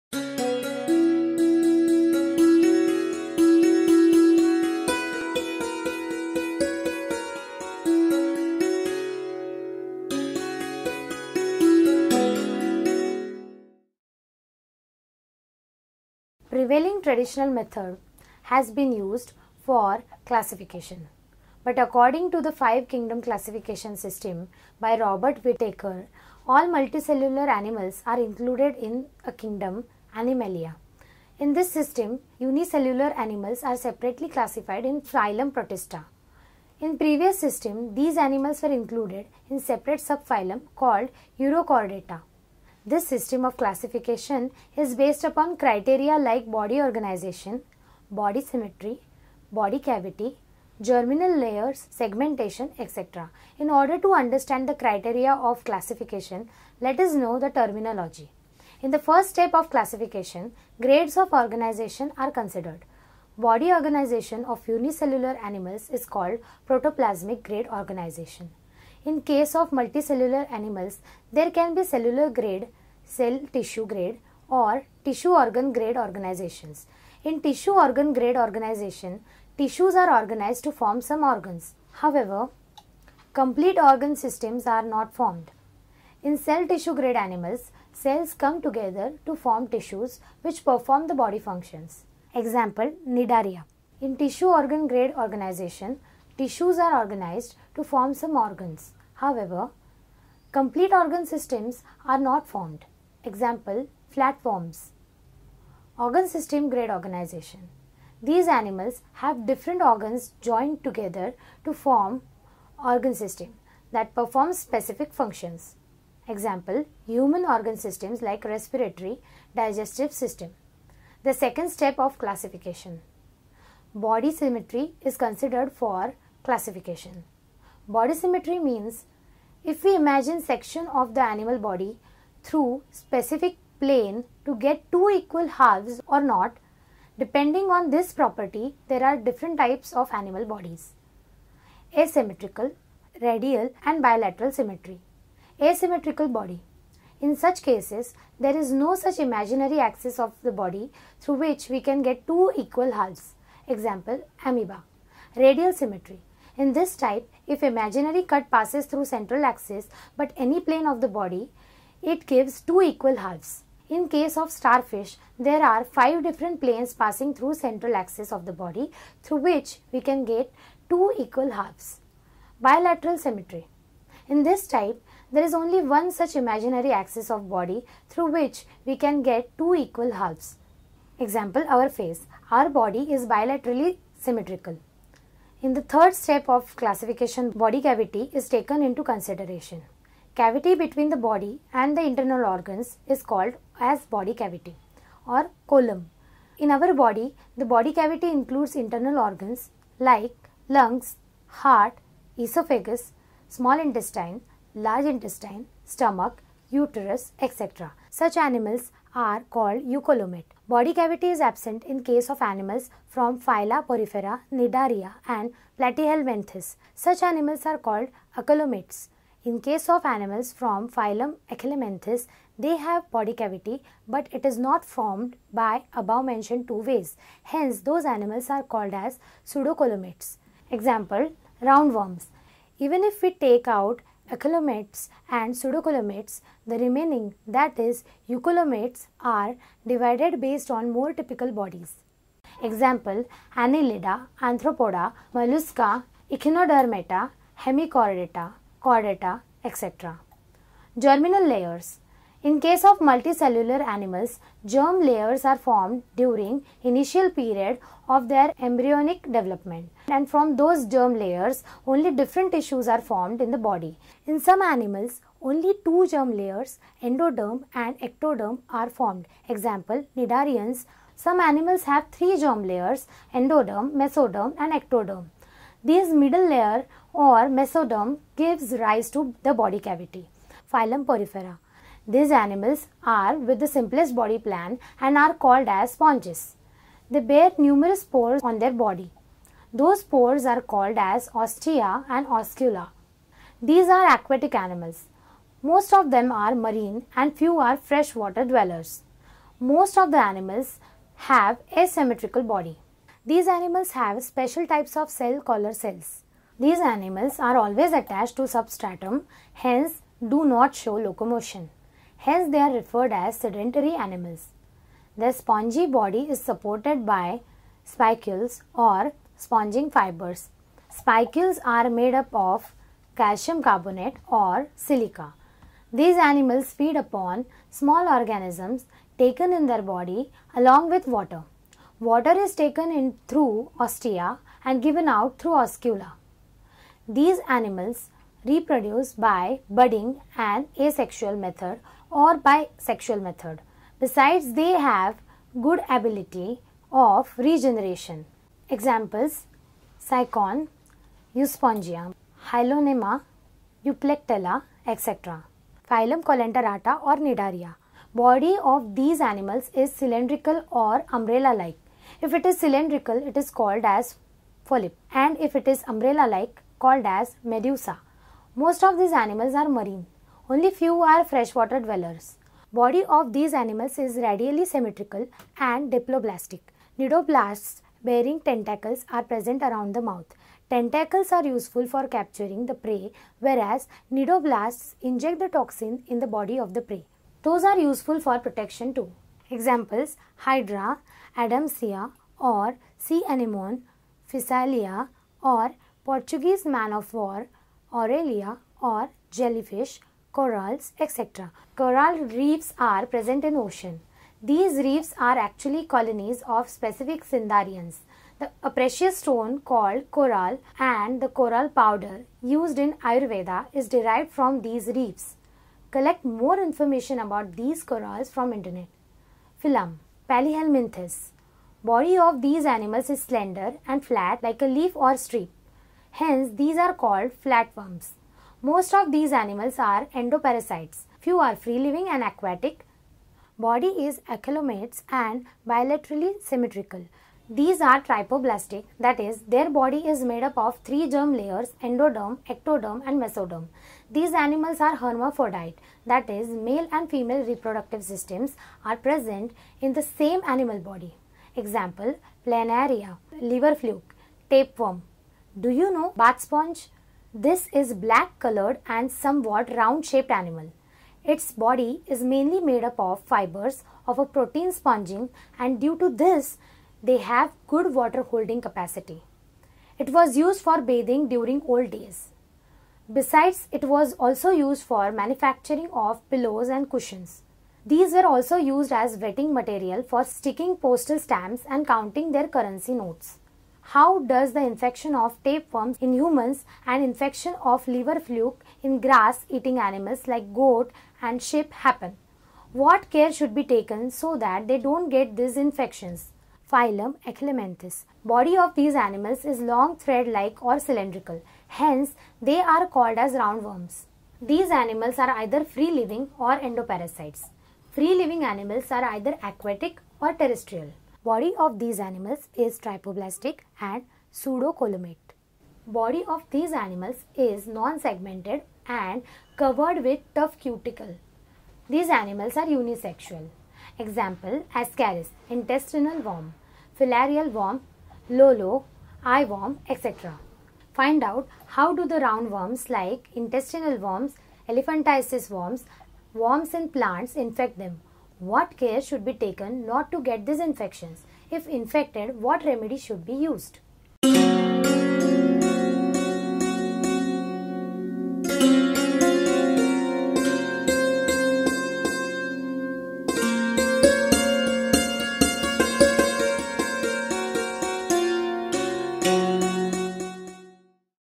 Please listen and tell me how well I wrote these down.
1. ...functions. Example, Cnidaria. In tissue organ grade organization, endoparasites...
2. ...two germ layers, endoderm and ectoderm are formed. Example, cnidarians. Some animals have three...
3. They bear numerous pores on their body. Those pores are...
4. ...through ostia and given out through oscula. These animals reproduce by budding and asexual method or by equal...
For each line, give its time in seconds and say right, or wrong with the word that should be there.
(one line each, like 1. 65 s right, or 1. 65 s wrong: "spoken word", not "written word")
1. 91 s wrong: "tissues", not "endoparasites"
2. 265 s right
3. 287 s right
4. 333 s wrong: "sexual", not "equal".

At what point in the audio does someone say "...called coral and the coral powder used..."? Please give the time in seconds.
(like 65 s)
409 s.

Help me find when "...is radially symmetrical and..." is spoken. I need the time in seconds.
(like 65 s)
373 s.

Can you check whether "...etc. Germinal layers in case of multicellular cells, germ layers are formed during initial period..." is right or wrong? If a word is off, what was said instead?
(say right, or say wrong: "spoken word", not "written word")
wrong: "animals", not "cells".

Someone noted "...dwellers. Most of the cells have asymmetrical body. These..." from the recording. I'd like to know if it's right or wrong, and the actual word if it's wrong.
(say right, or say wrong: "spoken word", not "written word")
wrong: "animals", not "cells".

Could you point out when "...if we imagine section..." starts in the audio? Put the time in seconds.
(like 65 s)
129 s.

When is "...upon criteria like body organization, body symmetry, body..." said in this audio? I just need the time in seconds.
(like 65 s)
45 s.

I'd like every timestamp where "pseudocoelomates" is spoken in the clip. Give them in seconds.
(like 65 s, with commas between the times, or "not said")
229 s, 235 s, 514 s.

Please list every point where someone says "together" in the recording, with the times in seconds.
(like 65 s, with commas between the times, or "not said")
88 s, 110 s.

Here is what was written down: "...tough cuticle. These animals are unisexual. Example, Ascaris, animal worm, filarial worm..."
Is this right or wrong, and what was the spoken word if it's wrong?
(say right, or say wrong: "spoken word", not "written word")
wrong: "intestinal", not "animal".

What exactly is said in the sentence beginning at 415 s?
Collect more information about these corals from internet.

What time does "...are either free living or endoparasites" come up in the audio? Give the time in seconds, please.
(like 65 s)
505 s.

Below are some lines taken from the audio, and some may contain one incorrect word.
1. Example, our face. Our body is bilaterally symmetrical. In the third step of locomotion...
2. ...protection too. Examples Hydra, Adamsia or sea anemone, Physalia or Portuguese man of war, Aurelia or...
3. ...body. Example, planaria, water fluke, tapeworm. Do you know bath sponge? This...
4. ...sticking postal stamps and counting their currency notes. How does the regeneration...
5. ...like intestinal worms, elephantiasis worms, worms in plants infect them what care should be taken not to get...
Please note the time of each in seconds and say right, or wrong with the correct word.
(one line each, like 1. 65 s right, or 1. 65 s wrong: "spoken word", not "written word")
1. 181 s wrong: "classification", not "locomotion"
2. 388 s right
3. 450 s wrong: "liver", not "water"
4. 480 s wrong: "infection", not "regeneration"
5. 532 s right.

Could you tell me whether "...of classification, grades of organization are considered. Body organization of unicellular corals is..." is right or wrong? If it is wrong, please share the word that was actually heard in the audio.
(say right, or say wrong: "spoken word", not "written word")
wrong: "animals", not "corals".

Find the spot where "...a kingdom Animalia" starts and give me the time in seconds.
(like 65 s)
29 s.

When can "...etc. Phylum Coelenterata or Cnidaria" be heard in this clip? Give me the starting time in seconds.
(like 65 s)
354 s.